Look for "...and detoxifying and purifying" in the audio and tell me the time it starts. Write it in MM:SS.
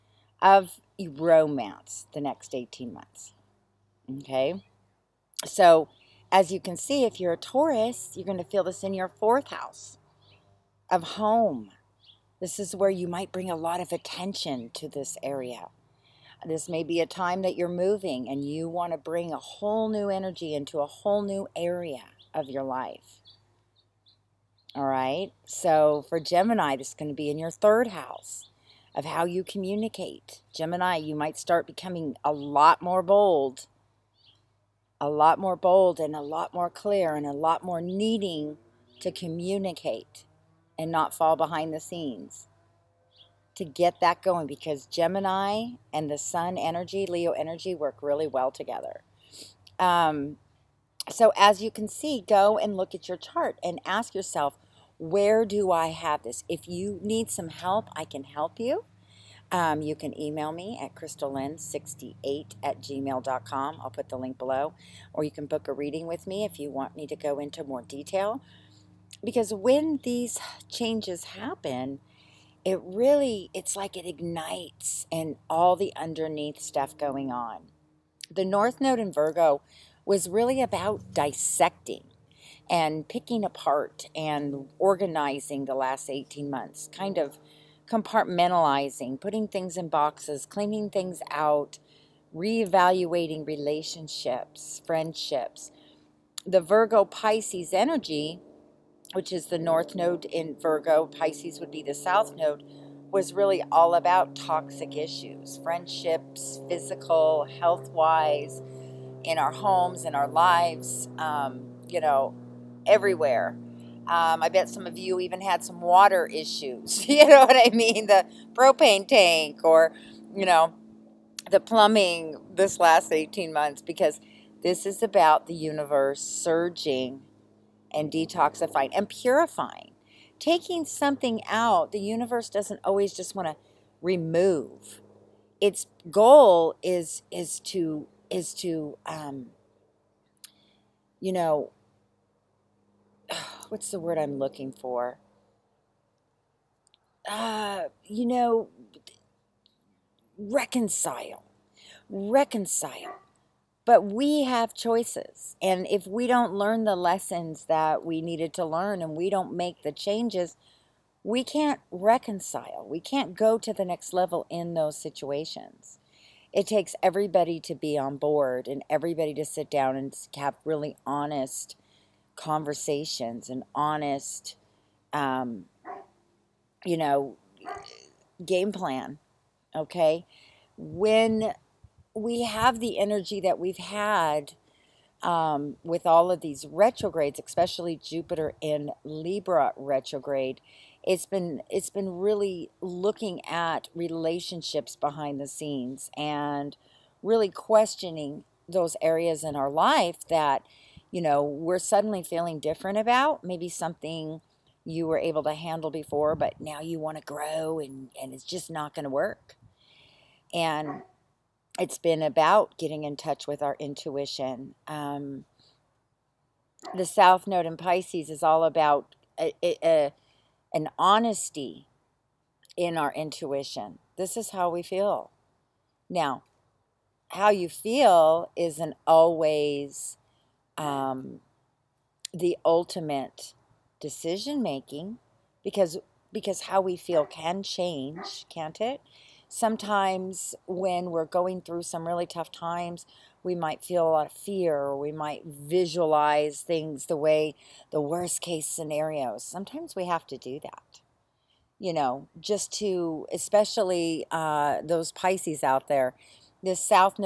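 02:07.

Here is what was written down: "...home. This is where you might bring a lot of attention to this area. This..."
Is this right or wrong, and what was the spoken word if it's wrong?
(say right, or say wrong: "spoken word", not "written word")
right.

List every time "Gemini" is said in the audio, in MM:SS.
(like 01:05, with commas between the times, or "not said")
00:26, 00:30, 00:44.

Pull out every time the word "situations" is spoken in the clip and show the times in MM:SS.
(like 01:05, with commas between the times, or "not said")
02:44.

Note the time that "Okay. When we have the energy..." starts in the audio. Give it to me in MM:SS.
02:59.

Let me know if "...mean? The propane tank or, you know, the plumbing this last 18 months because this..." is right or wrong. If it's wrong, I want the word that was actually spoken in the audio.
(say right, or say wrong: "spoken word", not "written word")
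right.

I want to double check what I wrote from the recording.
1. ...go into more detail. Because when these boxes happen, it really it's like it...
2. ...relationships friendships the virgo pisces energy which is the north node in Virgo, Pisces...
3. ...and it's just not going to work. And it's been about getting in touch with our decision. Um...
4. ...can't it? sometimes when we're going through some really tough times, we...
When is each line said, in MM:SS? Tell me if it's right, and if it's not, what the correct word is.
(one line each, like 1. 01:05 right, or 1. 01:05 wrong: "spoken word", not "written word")
1. 01:07 wrong: "changes", not "boxes"
2. 01:33 right
3. 03:28 wrong: "intuition", not "decision"
4. 03:58 right.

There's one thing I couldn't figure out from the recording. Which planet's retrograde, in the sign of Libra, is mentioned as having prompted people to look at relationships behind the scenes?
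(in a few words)
Jupiter.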